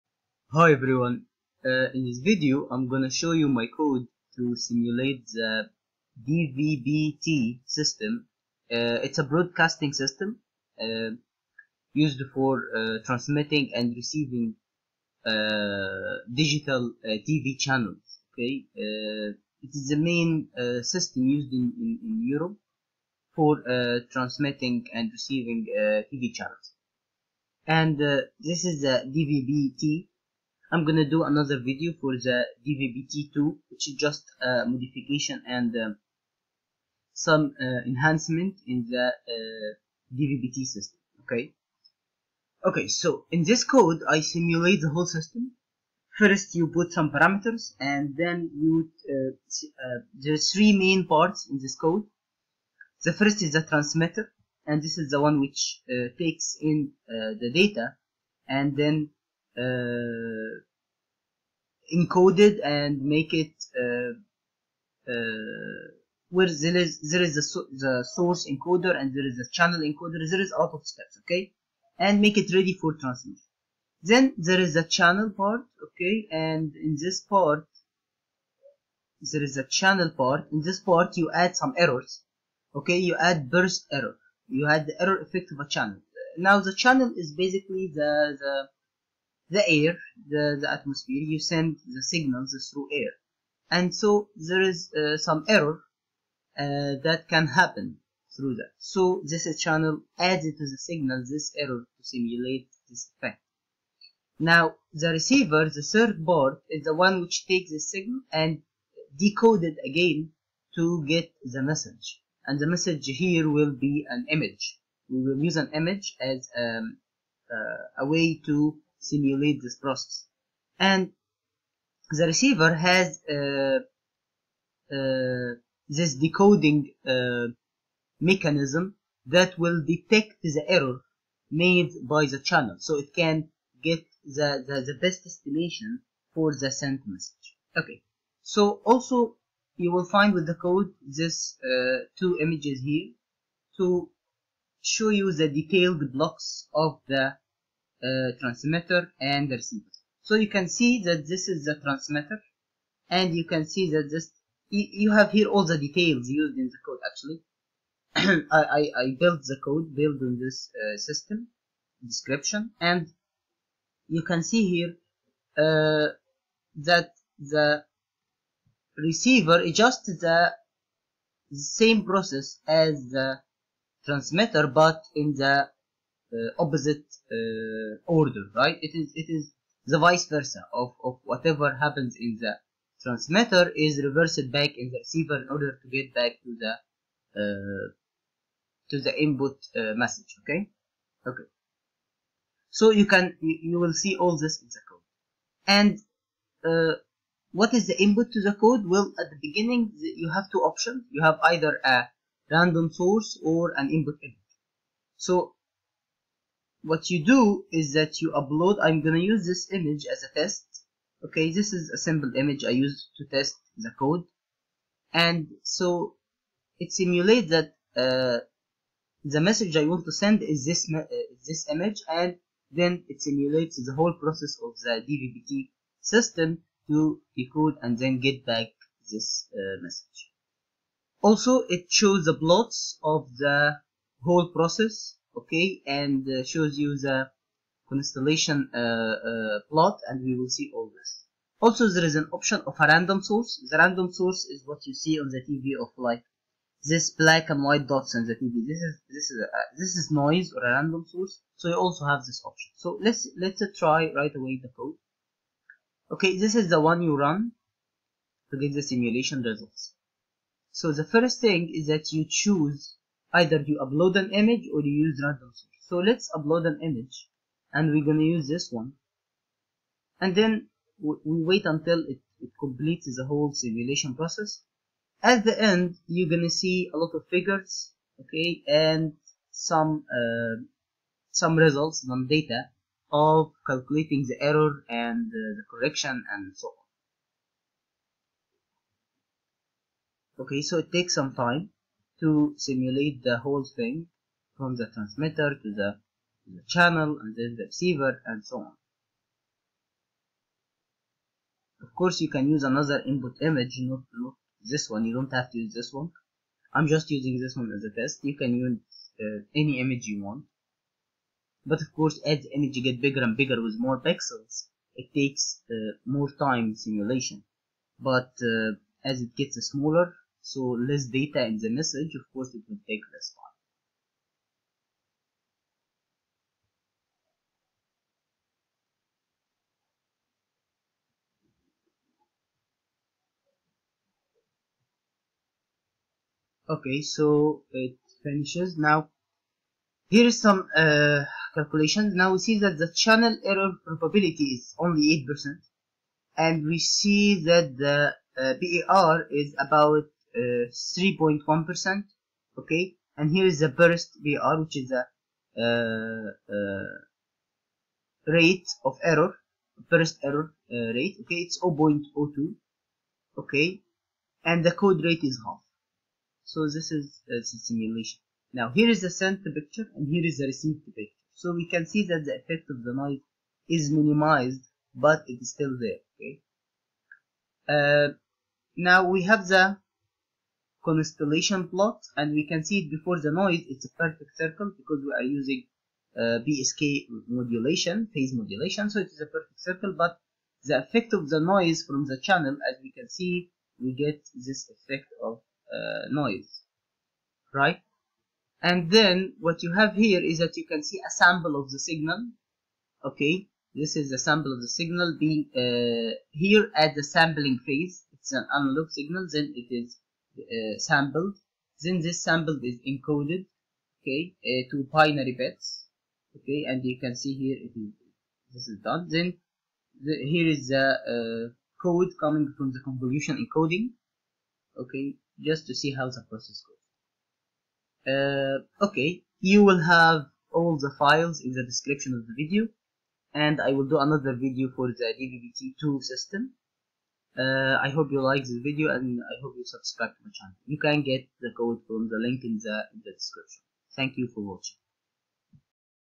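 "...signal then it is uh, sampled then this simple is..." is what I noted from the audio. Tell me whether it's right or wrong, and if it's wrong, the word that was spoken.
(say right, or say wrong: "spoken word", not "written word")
wrong: "sample", not "simple".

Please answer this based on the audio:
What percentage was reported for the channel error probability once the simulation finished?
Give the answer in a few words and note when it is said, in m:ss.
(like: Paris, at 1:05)
8%, at 5:45.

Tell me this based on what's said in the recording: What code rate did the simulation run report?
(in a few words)
Half.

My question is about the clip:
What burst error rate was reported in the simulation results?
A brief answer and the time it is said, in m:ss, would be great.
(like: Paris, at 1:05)
0.02, at 6:01.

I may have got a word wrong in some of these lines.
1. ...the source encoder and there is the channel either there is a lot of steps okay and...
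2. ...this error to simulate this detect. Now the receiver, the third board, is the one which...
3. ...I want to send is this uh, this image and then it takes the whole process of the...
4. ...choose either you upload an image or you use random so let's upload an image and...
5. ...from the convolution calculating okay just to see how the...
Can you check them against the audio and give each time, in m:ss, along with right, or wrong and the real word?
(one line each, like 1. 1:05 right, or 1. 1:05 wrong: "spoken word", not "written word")
1. 1:07 wrong: "encoder", not "either"
2. 1:41 wrong: "effect", not "detect"
3. 3:39 wrong: "simulates", not "takes"
4. 4:22 right
5. 7:02 wrong: "encoding", not "calculating".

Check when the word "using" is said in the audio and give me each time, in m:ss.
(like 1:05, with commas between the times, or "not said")
5:07, 6:25.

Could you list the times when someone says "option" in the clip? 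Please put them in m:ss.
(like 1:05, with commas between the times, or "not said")
3:20, 4:02, 4:12.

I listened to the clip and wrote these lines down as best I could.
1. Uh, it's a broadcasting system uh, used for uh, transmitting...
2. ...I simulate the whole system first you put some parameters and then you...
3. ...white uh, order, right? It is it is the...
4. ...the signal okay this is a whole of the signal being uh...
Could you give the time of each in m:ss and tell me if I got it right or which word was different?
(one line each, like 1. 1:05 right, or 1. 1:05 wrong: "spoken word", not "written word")
1. 0:08 right
2. 0:44 right
3. 2:56 wrong: "opposite", not "white"
4. 6:41 wrong: "sample", not "whole".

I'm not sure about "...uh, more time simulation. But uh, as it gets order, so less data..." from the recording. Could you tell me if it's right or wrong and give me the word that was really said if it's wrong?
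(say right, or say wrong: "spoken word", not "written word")
wrong: "smaller", not "order".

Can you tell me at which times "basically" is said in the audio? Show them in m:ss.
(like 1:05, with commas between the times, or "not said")
1:27.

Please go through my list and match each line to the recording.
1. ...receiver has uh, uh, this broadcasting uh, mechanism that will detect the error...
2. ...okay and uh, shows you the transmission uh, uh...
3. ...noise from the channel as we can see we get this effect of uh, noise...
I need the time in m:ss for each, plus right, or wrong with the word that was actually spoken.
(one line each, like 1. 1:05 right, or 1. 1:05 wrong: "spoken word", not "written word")
1. 2:02 wrong: "decoding", not "broadcasting"
2. 3:55 wrong: "constellation", not "transmission"
3. 6:31 right.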